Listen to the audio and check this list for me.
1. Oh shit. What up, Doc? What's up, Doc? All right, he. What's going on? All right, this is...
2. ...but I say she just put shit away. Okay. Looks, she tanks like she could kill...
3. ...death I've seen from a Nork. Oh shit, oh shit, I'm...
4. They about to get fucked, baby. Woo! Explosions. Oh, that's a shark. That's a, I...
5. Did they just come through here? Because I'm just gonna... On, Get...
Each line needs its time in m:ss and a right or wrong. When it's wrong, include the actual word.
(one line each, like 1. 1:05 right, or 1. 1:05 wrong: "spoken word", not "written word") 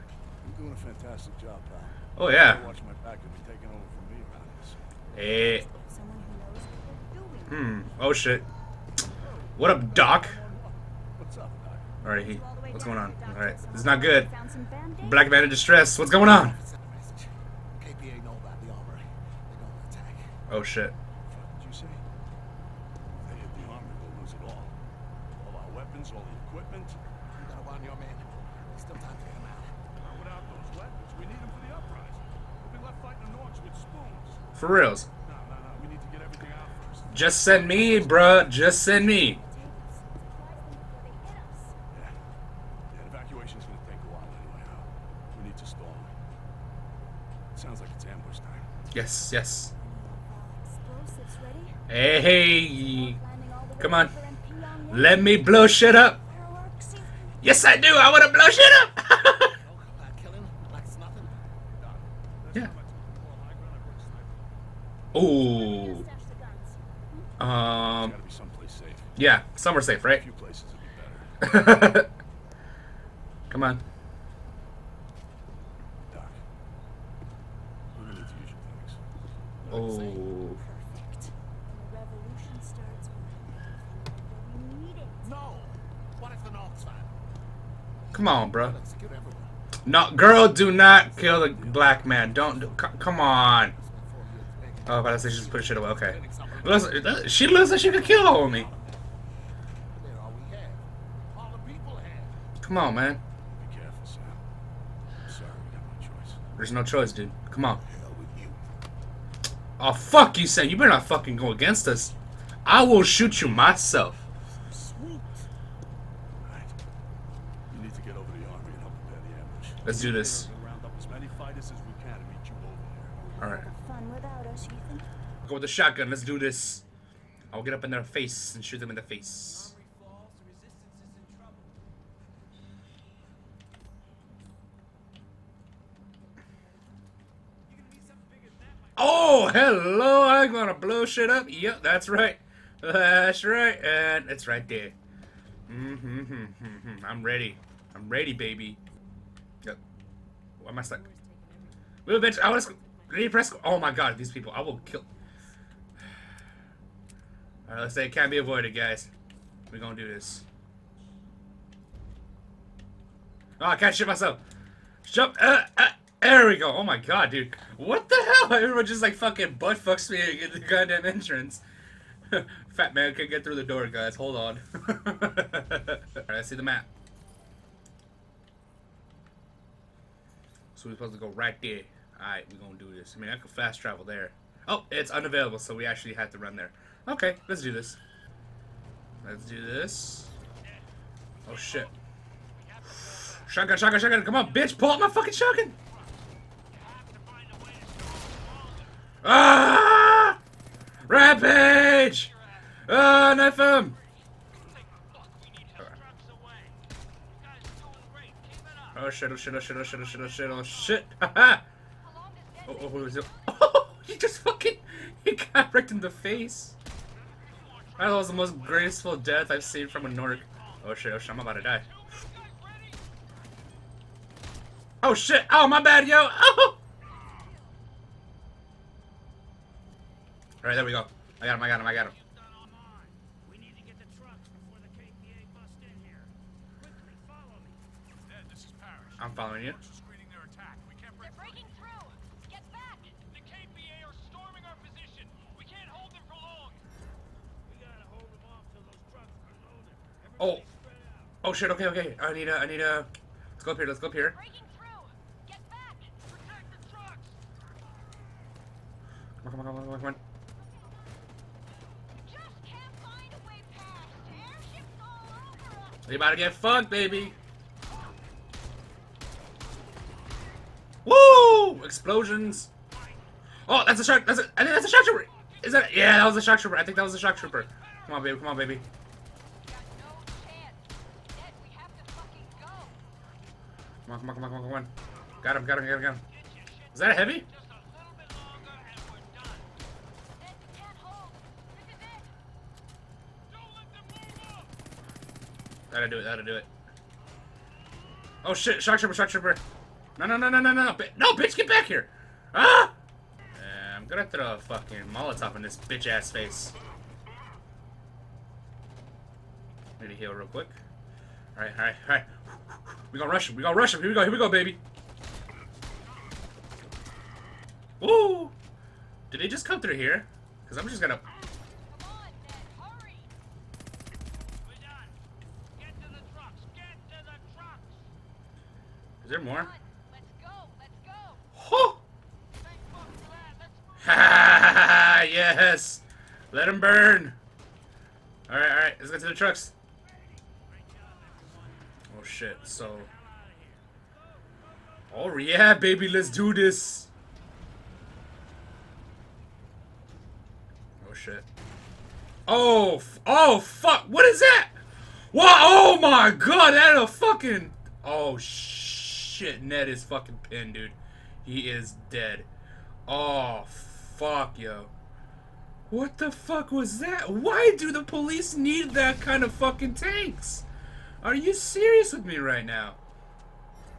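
1. 0:08 right
2. 1:35 wrong: "looks", not "tanks"
3. 3:39 right
4. 4:26 right
5. 5:19 right.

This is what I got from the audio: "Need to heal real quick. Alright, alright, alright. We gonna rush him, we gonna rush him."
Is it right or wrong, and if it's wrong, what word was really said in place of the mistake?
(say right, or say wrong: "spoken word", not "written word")
right.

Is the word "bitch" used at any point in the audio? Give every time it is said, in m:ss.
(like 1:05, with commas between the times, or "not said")
2:32, 3:14, 5:01, 5:05.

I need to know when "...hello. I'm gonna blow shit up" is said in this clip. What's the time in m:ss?
2:19.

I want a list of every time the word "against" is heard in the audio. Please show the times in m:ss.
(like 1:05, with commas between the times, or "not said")
1:51.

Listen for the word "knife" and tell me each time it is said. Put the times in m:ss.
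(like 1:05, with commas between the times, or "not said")
3:23.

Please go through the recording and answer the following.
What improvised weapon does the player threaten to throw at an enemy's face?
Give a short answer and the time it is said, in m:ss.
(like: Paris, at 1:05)
Molotov, at 5:05.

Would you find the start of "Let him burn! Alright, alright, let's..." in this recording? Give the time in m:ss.
5:36.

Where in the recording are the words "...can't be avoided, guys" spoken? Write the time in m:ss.
2:38.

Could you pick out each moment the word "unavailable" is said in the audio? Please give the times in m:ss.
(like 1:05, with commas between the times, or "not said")
3:05.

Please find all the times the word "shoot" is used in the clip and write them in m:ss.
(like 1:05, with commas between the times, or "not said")
1:53, 2:08.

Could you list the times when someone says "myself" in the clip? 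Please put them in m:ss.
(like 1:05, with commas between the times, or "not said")
1:53, 2:44.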